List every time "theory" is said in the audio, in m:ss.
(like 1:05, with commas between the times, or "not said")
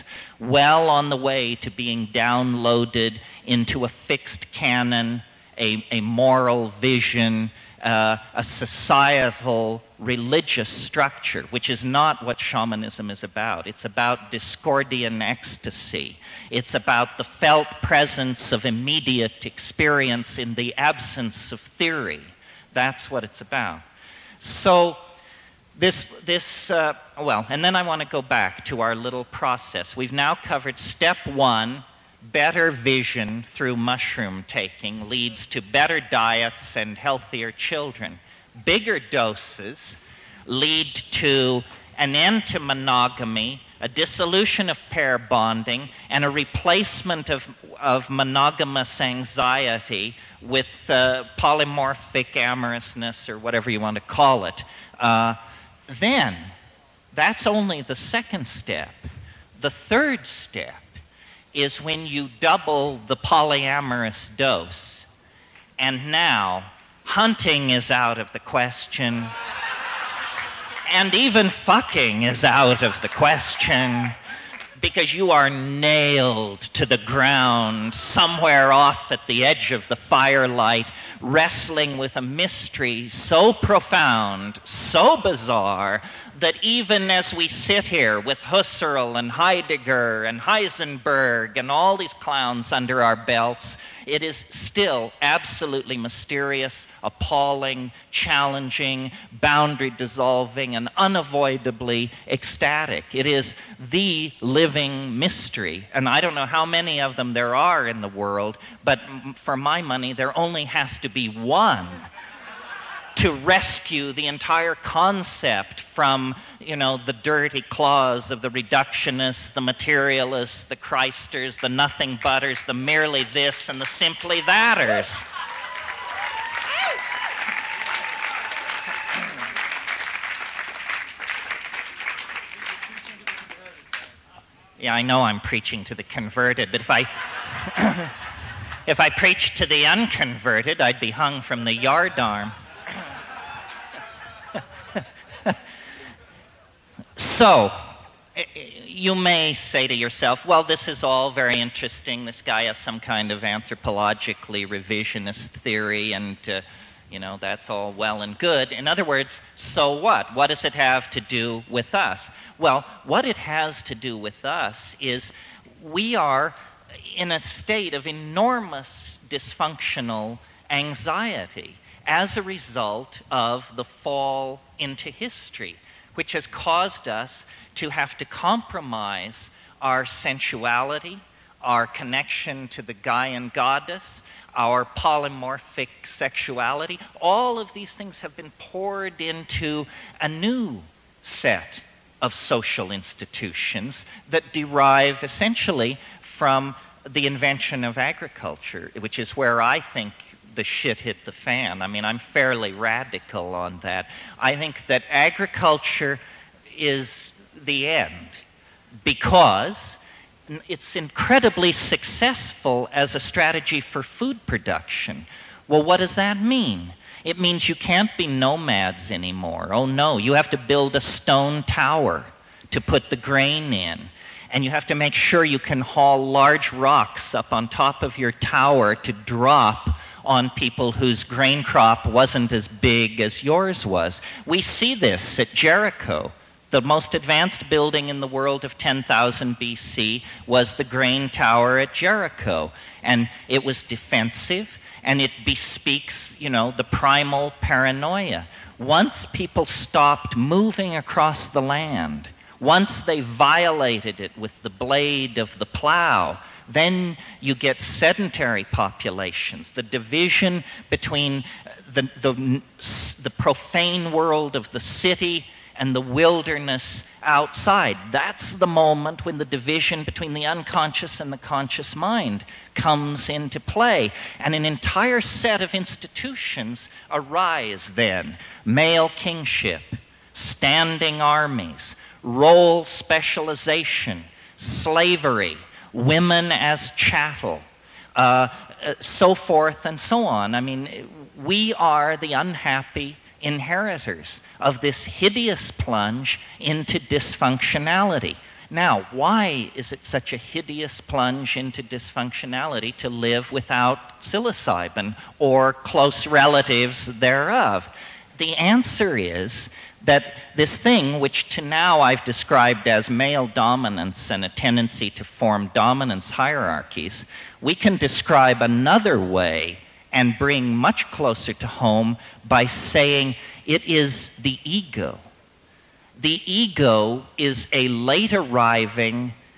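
0:21, 2:35.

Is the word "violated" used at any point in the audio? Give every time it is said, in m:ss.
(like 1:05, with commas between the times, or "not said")
4:13.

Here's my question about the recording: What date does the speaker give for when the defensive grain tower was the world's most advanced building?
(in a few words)
10,000 BC.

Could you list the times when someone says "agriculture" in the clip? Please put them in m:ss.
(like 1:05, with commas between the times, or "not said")
3:17, 3:25.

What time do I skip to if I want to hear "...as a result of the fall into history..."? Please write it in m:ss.
2:52.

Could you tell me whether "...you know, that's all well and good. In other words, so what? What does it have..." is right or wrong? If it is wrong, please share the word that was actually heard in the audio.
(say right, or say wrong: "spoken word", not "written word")
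right.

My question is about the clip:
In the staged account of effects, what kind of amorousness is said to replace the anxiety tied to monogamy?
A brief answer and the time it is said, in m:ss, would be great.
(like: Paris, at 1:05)
polymorphic amorousness, at 0:51.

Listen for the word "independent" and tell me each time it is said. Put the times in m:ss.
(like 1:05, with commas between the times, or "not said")
not said.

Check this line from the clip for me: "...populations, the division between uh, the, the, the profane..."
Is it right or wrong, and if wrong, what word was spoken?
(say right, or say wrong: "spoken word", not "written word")
right.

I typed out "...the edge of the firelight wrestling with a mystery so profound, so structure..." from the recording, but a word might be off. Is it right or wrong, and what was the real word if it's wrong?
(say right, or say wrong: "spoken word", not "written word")
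wrong: "bizarre", not "structure".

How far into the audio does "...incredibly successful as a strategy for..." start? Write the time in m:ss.
3:30.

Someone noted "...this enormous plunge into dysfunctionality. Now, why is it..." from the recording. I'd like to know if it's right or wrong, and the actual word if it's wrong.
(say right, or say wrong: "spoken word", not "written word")
wrong: "hideous", not "enormous".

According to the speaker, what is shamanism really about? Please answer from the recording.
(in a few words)
discordian ecstasy.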